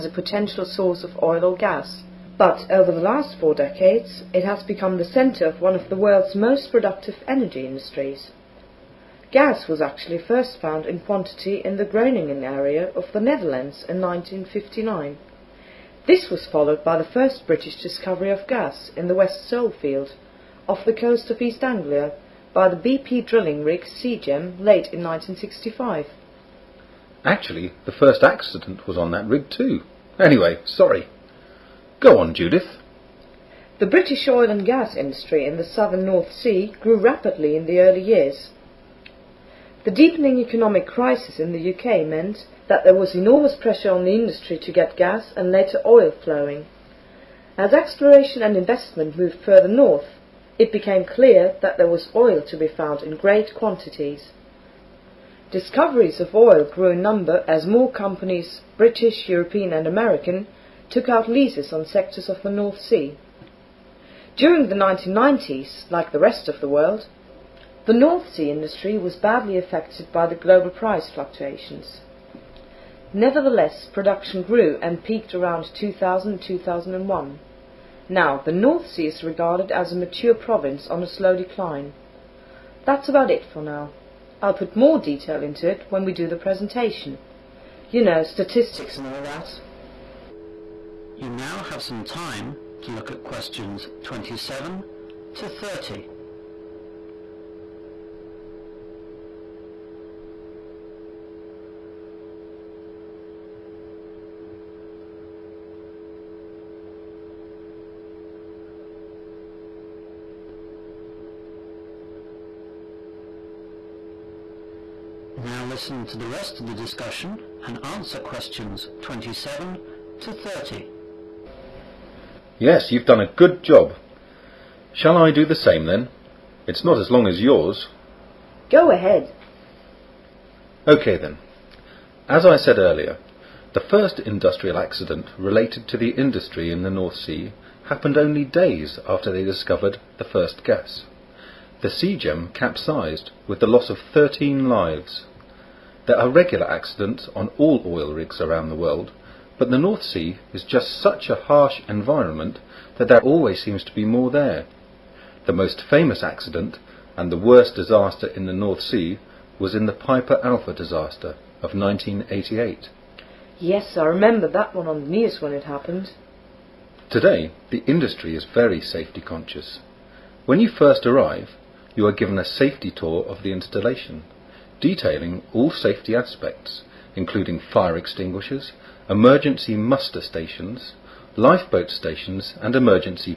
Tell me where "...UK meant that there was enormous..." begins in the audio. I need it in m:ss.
0:41.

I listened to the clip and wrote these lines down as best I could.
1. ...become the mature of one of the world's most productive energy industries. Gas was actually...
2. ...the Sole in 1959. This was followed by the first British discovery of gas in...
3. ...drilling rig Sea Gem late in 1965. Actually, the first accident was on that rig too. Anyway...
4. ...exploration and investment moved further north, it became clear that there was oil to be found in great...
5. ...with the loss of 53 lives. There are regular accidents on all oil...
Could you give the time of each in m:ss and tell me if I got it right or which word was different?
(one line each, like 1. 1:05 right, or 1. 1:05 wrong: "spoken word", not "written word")
1. 0:04 wrong: "centre", not "mature"
2. 0:13 wrong: "Netherlands", not "Sole"
3. 0:23 right
4. 0:47 right
5. 2:23 wrong: "13", not "53".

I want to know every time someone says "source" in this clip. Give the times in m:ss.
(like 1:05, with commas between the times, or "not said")
0:00.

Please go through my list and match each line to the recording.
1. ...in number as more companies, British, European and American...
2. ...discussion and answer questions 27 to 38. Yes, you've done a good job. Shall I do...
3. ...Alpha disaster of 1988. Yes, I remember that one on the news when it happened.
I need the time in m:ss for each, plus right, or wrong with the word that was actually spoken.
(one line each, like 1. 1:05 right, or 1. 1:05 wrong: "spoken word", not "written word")
1. 0:56 right
2. 1:56 wrong: "30", not "38"
3. 2:40 right.